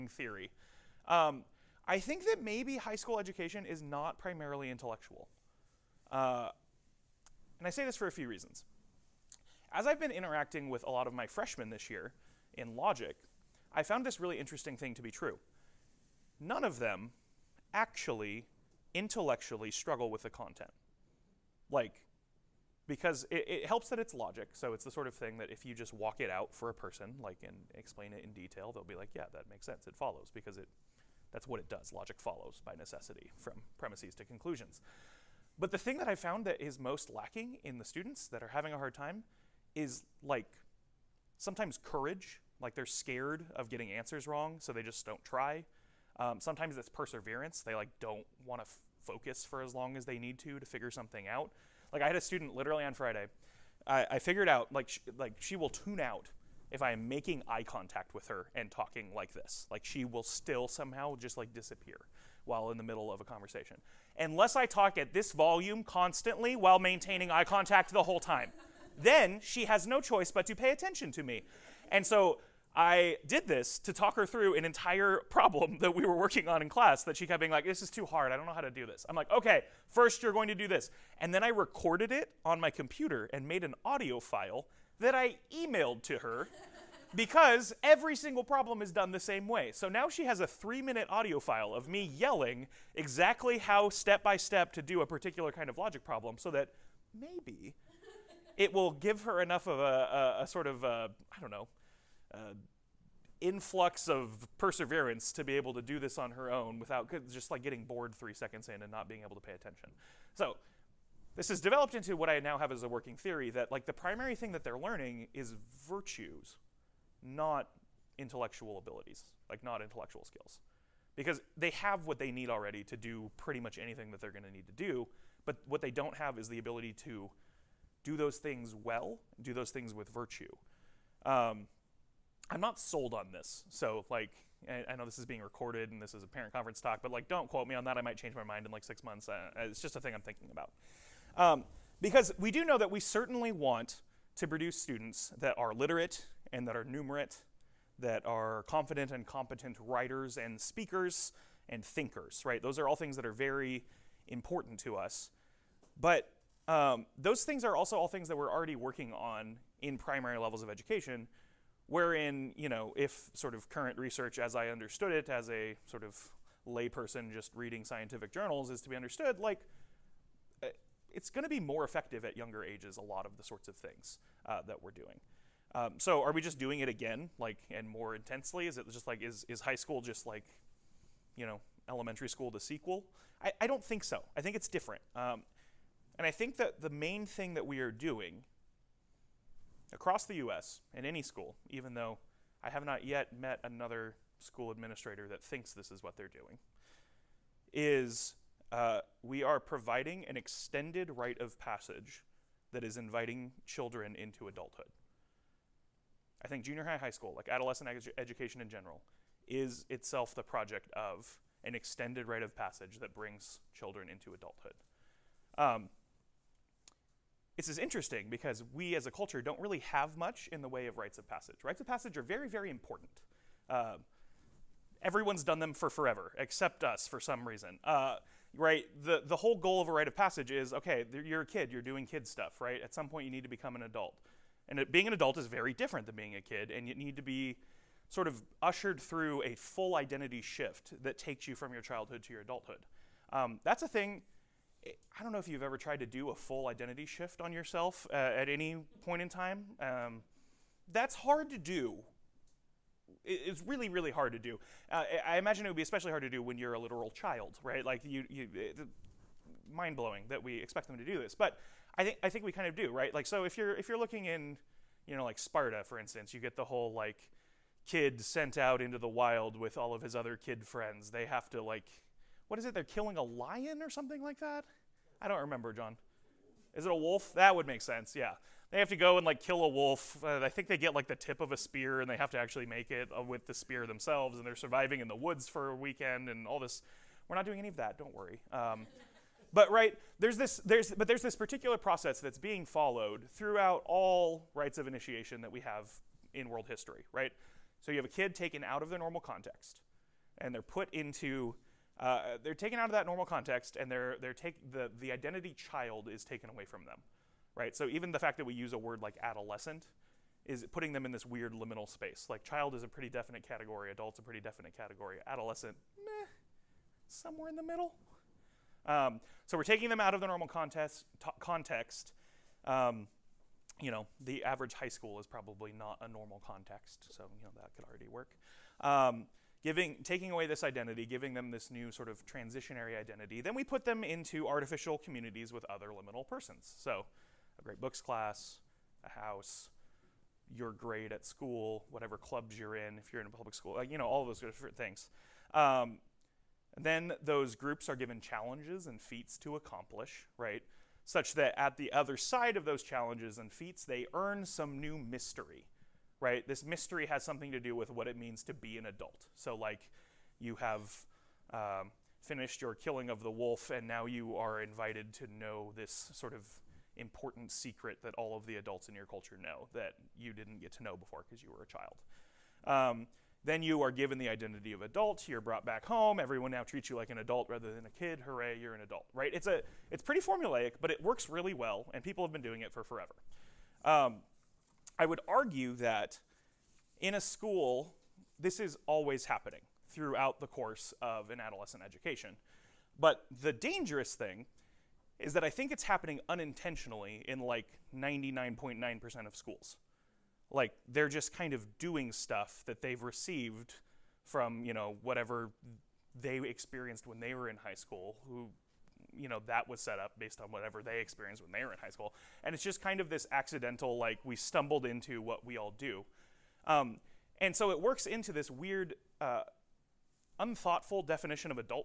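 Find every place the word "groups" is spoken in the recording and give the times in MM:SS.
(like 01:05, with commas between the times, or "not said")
05:47.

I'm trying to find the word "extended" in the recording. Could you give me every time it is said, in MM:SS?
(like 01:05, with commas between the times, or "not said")
03:20, 03:31.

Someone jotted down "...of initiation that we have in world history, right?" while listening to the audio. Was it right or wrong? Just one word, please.
right.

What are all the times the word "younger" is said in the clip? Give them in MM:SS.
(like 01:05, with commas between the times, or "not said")
02:52.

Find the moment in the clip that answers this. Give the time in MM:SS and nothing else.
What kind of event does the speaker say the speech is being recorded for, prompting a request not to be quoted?
02:16.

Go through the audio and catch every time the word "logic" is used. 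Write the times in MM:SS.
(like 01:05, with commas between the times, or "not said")
00:12, 00:24, 00:31, 01:35.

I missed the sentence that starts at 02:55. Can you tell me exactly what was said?
Um, so are we just doing it again, like, and more intensely?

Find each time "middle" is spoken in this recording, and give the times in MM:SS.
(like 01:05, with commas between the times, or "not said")
01:02, 05:17.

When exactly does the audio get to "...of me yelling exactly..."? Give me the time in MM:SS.
01:31.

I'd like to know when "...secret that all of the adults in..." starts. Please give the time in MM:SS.
06:07.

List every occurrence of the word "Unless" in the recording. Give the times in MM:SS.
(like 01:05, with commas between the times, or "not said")
01:04.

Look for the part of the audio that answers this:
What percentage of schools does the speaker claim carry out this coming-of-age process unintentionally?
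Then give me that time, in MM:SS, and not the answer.
06:37.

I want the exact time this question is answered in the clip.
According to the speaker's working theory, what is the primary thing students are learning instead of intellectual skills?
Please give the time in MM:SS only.
01:55.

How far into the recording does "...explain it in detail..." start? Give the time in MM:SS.
00:27.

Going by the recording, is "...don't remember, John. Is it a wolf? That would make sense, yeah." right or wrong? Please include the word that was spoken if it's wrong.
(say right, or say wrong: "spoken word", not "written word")
right.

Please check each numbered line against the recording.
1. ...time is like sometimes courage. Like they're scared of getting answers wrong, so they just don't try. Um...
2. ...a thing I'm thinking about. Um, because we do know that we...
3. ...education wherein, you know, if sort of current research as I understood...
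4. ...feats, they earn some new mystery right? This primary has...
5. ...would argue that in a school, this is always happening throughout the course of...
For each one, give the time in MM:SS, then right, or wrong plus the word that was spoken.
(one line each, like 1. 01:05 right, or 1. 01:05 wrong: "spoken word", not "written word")
1. 00:38 right
2. 02:19 right
3. 02:40 right
4. 05:53 wrong: "mystery", not "primary"
5. 06:25 right.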